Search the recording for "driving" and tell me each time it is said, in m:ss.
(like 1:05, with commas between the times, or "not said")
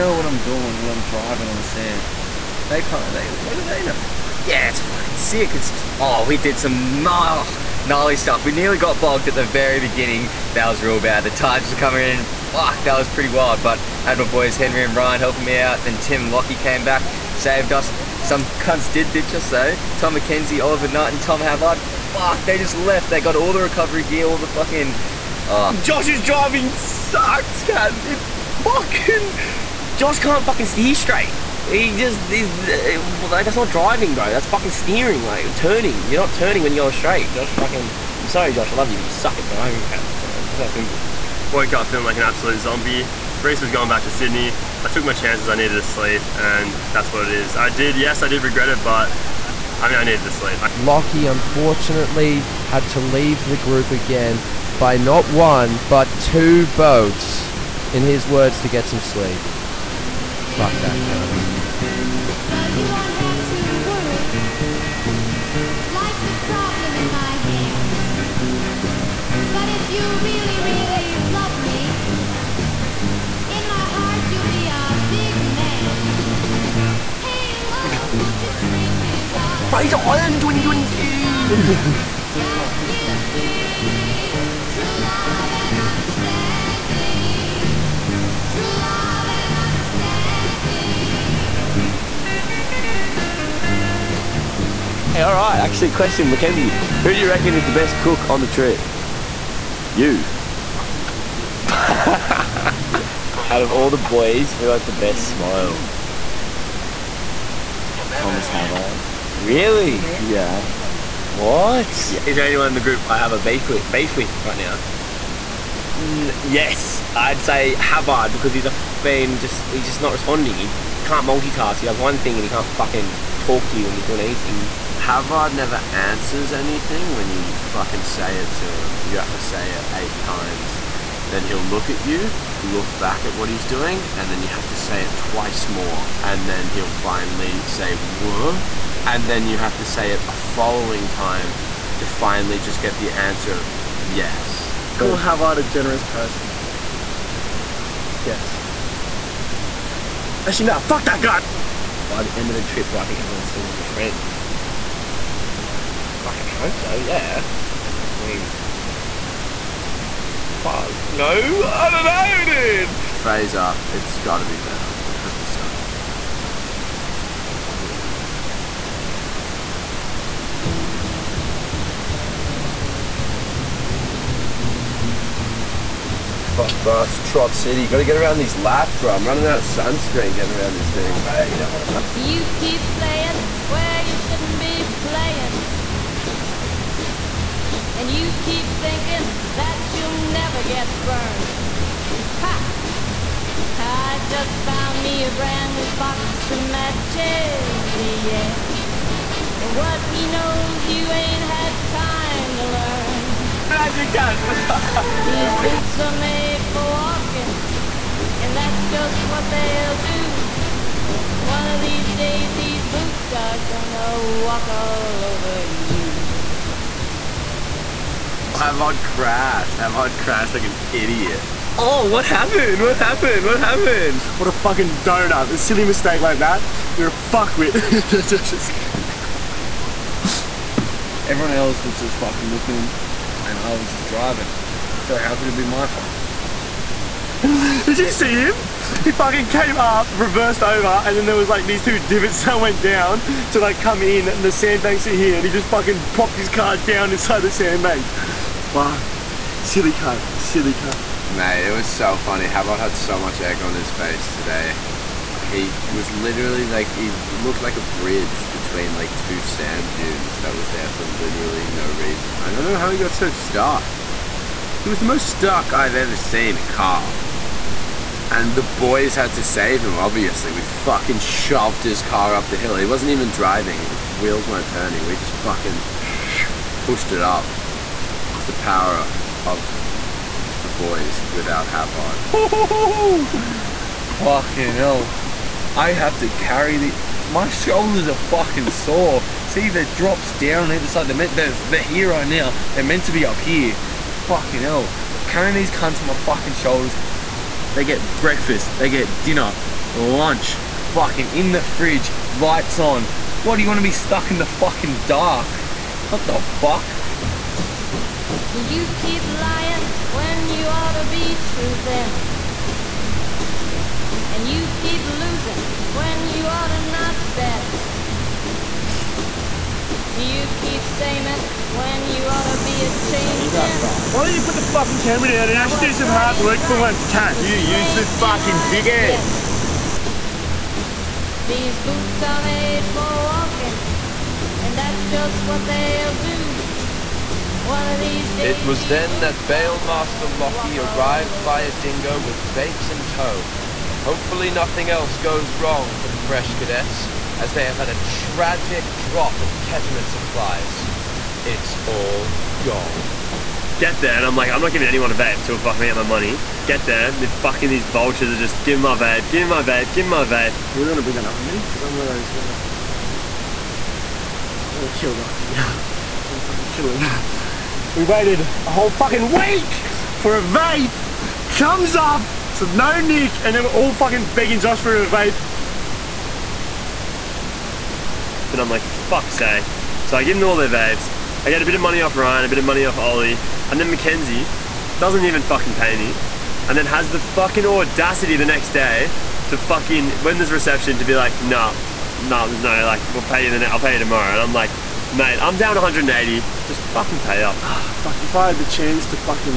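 0:01, 0:26, 0:33, 0:39, 3:54, 4:33.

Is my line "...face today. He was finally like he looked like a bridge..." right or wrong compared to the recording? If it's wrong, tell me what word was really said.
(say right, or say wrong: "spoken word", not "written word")
wrong: "literally", not "finally".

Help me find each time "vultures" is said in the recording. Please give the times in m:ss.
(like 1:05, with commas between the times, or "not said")
5:57.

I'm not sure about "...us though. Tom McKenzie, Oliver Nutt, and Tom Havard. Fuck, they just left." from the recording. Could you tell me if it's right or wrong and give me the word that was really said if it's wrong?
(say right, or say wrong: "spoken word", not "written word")
right.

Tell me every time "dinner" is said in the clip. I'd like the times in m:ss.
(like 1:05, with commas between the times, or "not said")
4:59.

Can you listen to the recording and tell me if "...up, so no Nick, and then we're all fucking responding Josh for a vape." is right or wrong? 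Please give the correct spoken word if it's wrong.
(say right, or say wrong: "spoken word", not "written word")
wrong: "begging", not "responding".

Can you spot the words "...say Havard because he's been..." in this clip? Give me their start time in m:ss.
1:57.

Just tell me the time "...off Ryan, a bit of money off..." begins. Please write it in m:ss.
6:22.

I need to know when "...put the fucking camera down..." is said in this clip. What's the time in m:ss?
5:24.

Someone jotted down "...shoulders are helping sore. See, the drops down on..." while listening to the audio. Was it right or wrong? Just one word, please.
wrong.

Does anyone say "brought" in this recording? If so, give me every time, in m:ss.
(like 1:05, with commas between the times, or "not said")
not said.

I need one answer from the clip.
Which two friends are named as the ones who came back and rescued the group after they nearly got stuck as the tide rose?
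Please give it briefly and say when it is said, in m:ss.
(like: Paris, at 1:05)
Tim and Lockie, at 0:15.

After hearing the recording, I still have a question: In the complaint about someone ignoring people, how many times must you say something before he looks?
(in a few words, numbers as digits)
8.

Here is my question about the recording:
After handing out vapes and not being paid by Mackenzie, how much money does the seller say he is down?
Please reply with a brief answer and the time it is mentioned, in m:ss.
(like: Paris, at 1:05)
180, at 6:35.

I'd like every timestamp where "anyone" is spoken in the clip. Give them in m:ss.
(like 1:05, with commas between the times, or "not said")
1:52, 5:54.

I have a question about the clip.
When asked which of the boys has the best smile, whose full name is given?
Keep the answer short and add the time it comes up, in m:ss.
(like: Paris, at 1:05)
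Thomas Havard, at 1:48.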